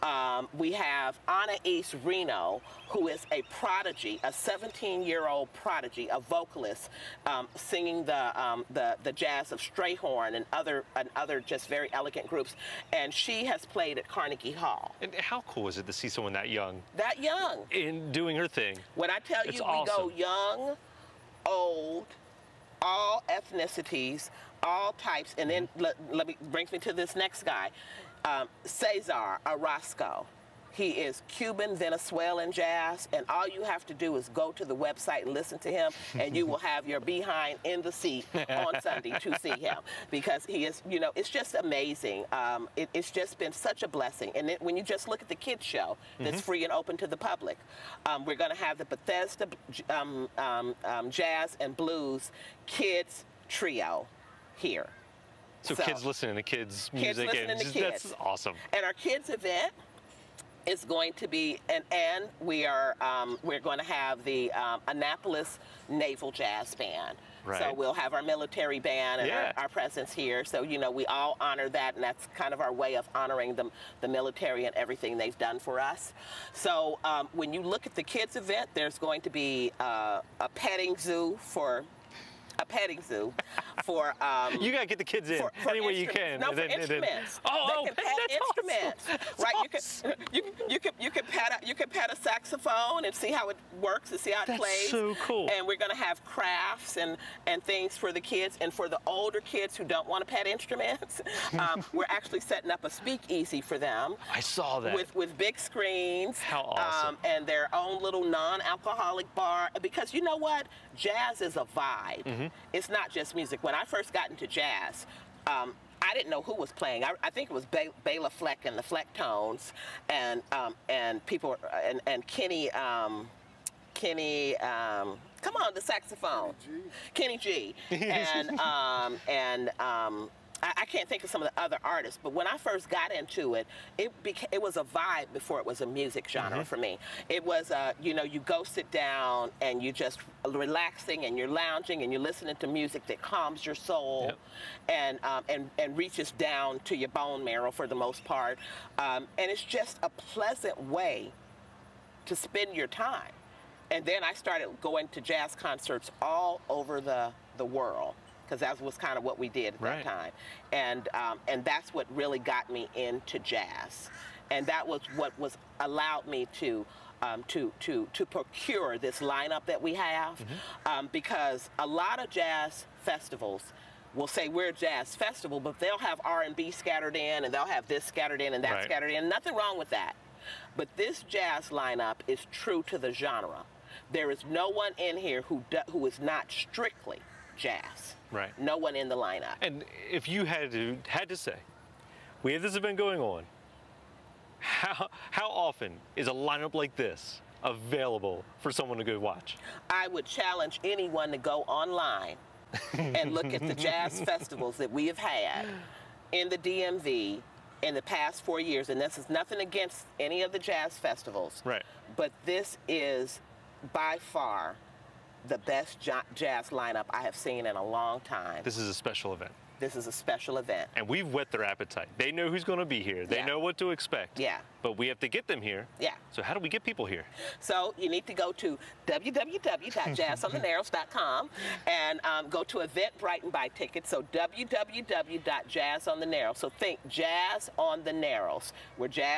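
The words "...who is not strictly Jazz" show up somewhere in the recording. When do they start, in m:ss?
3:05.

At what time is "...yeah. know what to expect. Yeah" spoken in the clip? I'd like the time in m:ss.
3:43.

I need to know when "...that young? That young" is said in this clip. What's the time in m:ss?
0:16.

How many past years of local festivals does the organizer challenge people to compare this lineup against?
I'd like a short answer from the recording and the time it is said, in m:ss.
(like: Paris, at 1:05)
4, at 3:28.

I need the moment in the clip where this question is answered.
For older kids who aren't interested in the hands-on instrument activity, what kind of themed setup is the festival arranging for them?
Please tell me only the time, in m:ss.
1:42.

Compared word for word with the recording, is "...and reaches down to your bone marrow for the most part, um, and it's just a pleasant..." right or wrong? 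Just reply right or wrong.
right.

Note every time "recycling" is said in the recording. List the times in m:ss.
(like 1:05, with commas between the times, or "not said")
not said.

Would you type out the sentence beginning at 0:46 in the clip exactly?
free and open to the public, um, we're going to have the Bethesda um, um, um, Jazz and Blues Kids Trio here.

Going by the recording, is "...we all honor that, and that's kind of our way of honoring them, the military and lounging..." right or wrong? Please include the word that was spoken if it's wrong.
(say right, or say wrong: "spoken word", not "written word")
wrong: "everything", not "lounging".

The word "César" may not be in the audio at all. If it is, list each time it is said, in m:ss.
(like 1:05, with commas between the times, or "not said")
0:28.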